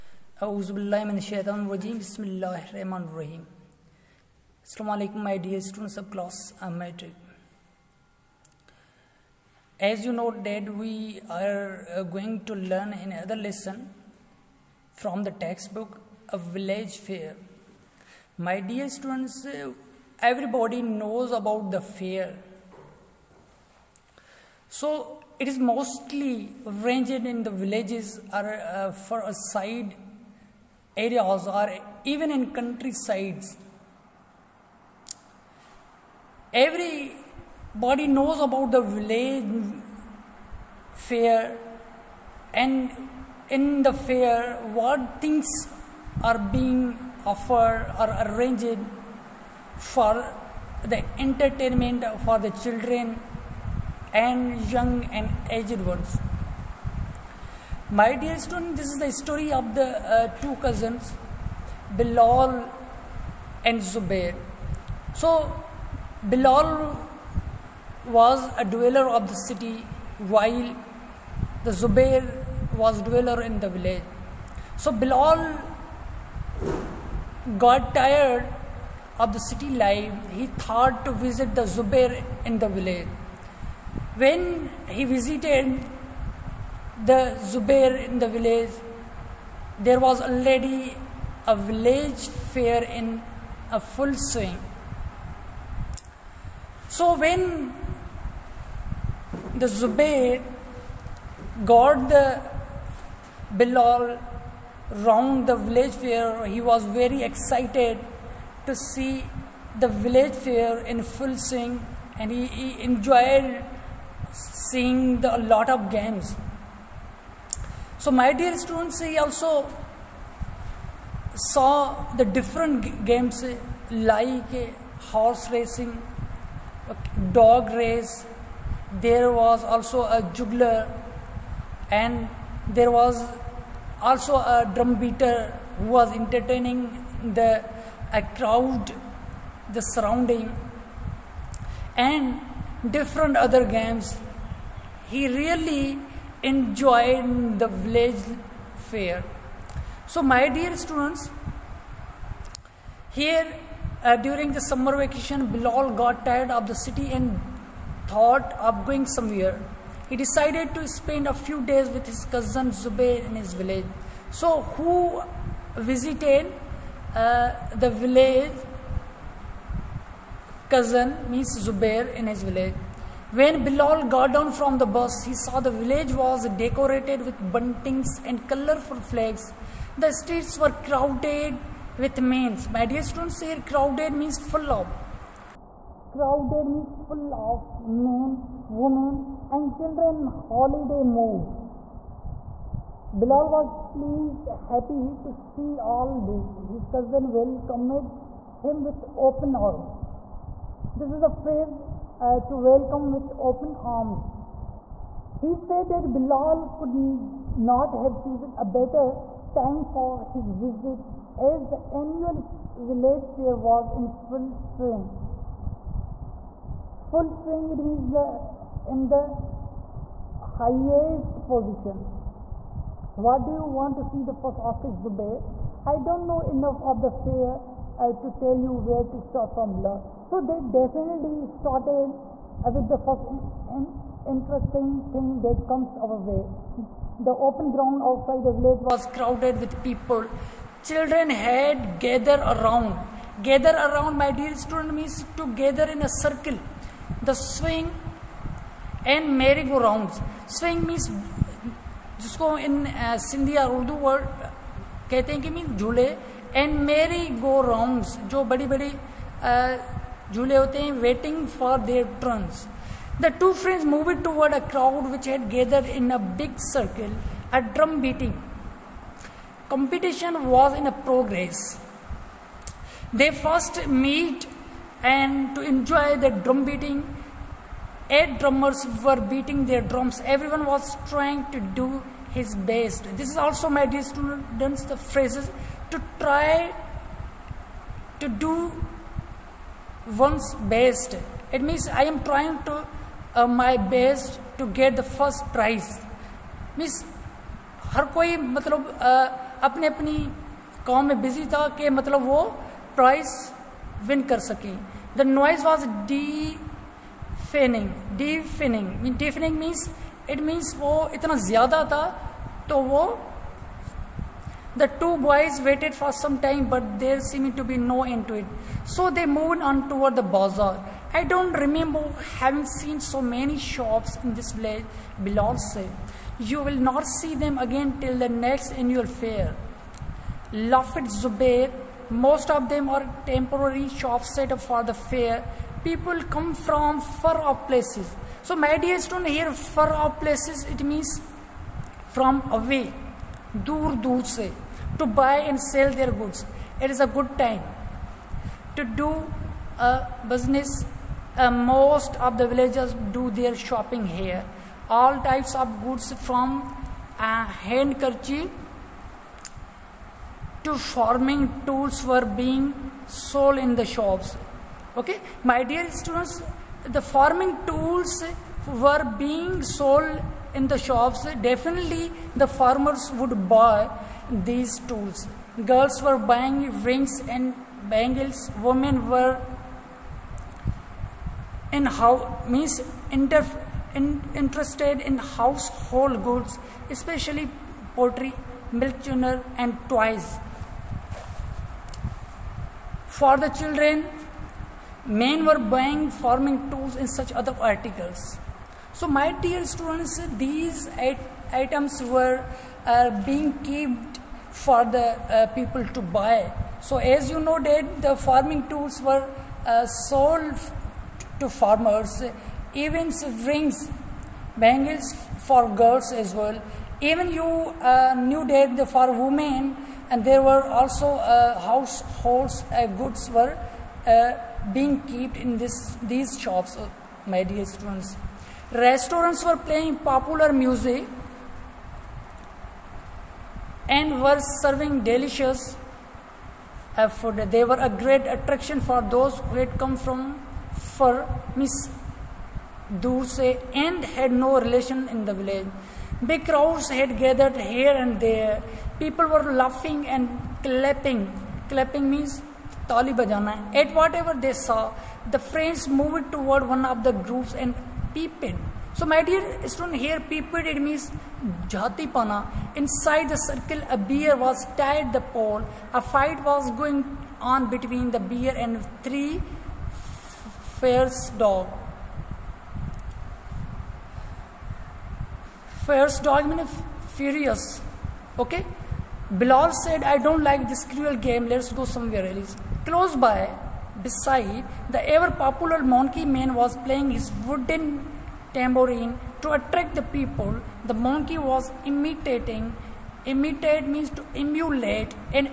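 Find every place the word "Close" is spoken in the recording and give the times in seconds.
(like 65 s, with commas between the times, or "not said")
482 s.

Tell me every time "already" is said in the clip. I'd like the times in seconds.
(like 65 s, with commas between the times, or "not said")
90 s.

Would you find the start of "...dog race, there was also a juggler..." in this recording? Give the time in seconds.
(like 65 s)
127 s.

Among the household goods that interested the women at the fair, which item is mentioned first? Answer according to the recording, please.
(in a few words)
Pottery.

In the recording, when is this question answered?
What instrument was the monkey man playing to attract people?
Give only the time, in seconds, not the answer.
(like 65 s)
488 s.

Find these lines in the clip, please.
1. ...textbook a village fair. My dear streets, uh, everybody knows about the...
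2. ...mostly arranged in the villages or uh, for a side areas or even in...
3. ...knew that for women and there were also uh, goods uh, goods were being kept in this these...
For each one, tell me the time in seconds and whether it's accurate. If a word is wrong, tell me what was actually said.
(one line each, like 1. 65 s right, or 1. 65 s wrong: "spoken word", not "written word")
1. 15 s wrong: "students", not "streets"
2. 25 s right
3. 418 s wrong: "households", not "goods".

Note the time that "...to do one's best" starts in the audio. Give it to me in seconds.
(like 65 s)
288 s.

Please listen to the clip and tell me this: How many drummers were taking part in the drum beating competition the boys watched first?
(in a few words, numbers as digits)
8.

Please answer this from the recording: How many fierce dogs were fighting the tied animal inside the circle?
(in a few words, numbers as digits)
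3.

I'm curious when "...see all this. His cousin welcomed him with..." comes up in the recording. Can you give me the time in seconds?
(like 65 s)
195 s.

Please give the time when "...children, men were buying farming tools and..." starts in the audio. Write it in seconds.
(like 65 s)
393 s.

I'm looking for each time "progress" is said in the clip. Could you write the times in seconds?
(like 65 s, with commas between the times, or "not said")
271 s.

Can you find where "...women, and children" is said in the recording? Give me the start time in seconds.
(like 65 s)
188 s.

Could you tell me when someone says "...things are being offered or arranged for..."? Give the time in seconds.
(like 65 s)
45 s.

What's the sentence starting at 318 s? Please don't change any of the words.
So they moved on toward the bazaar.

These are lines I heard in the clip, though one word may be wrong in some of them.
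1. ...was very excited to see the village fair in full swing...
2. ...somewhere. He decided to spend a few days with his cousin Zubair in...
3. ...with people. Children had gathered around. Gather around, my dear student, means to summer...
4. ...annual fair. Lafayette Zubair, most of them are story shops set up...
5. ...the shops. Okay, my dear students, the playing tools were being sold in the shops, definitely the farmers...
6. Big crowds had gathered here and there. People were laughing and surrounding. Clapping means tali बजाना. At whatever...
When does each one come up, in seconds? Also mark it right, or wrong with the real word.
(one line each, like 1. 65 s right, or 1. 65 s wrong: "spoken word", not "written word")
1. 106 s right
2. 159 s right
3. 239 s wrong: "gather", not "summer"
4. 328 s wrong: "temporary", not "story"
5. 363 s wrong: "farming", not "playing"
6. 446 s wrong: "clapping", not "surrounding".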